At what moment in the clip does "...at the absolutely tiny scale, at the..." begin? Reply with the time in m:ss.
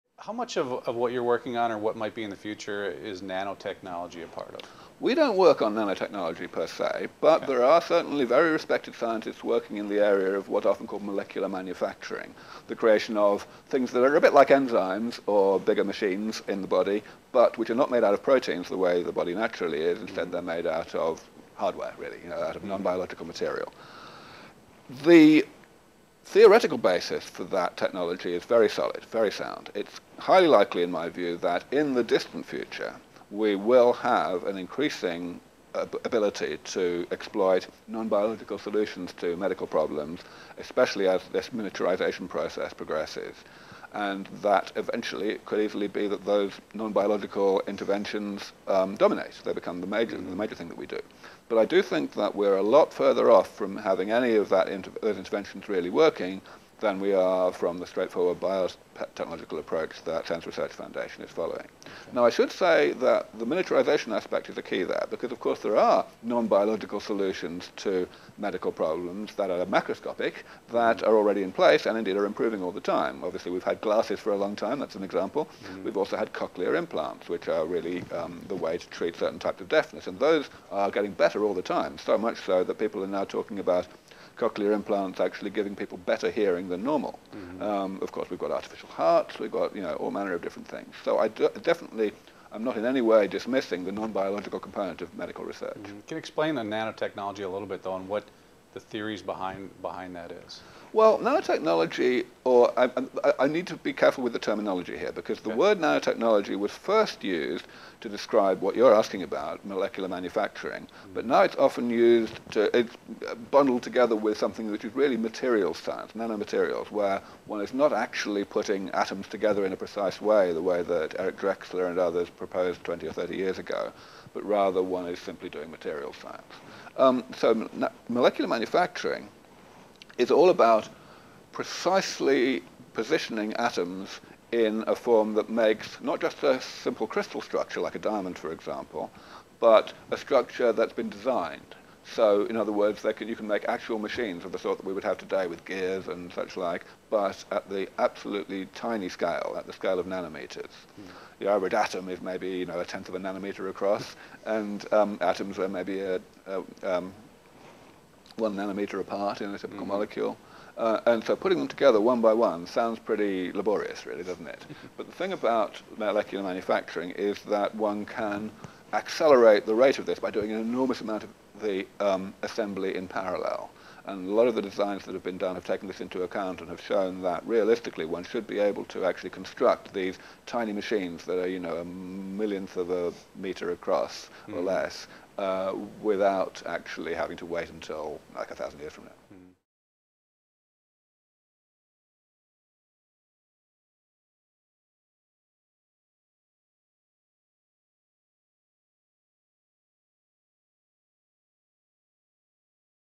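2:27.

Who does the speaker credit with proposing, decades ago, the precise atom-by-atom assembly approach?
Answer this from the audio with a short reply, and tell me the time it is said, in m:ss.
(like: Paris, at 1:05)
Eric Drexler, at 2:01.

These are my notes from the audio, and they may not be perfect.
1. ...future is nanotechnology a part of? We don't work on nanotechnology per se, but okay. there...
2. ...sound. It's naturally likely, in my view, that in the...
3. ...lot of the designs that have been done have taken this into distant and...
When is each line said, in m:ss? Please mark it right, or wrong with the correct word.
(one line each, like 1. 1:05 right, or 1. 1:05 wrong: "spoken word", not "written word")
1. 0:02 right
2. 0:29 wrong: "highly", not "naturally"
3. 2:54 wrong: "account", not "distant".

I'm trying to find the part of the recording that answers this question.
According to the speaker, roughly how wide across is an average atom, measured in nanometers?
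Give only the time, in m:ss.
2:32.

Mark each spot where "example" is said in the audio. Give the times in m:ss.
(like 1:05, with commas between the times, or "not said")
1:15, 2:18.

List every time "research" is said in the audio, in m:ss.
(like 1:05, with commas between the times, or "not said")
1:00, 1:35.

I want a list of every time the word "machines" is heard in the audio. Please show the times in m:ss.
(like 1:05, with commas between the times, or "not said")
0:15, 2:23, 3:00.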